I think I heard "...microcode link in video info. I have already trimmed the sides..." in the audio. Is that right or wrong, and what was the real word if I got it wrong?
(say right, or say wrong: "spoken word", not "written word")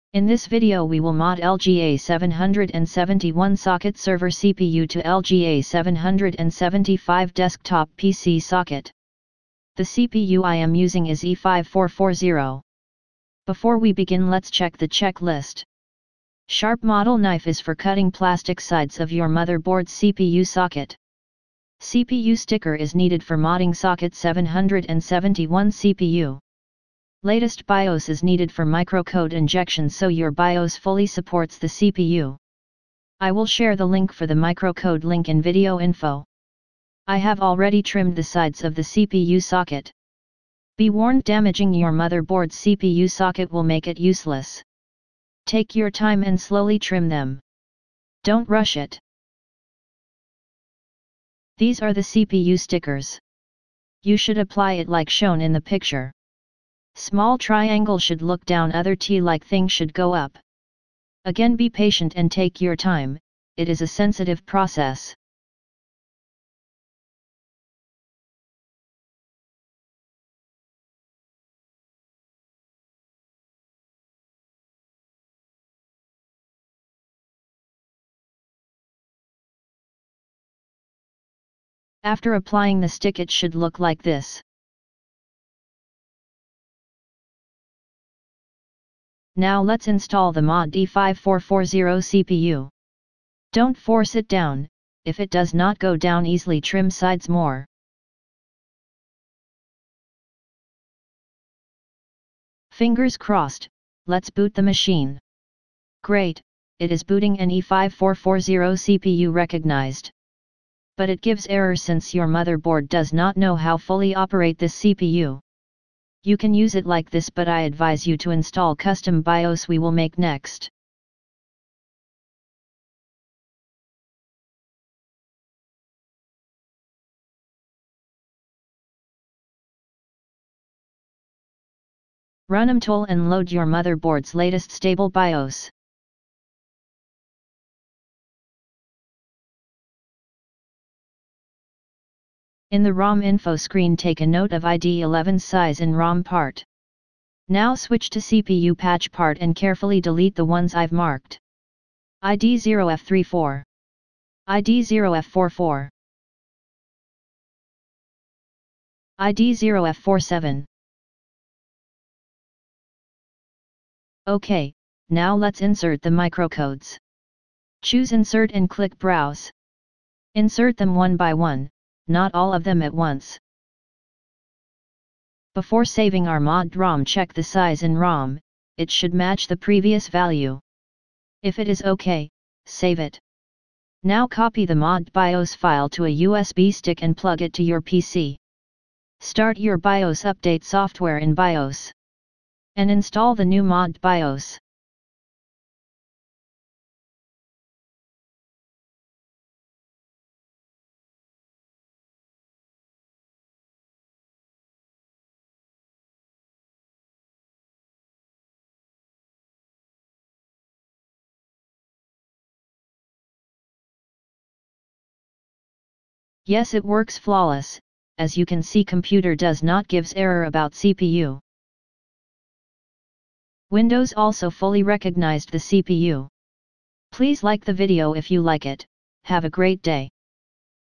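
right.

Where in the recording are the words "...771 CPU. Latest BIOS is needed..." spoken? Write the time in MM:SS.
00:24.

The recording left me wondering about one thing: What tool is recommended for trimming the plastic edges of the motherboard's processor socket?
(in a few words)
Sharp model knife.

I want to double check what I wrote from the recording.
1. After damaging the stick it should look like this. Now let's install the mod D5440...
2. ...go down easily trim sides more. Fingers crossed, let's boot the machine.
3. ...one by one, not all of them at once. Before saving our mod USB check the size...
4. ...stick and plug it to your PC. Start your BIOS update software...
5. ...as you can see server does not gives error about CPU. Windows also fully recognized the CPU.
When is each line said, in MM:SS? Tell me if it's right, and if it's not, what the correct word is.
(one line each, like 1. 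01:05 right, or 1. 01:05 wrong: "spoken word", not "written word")
1. 01:22 wrong: "applying", not "damaging"
2. 01:35 right
3. 02:50 wrong: "ROM", not "USB"
4. 03:06 right
5. 03:38 wrong: "computer", not "server".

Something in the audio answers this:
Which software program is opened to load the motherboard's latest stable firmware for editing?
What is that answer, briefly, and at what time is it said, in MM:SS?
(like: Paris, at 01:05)
MMTool, at 02:12.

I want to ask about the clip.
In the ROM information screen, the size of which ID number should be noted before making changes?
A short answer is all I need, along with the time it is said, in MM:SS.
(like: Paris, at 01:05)
11, at 02:24.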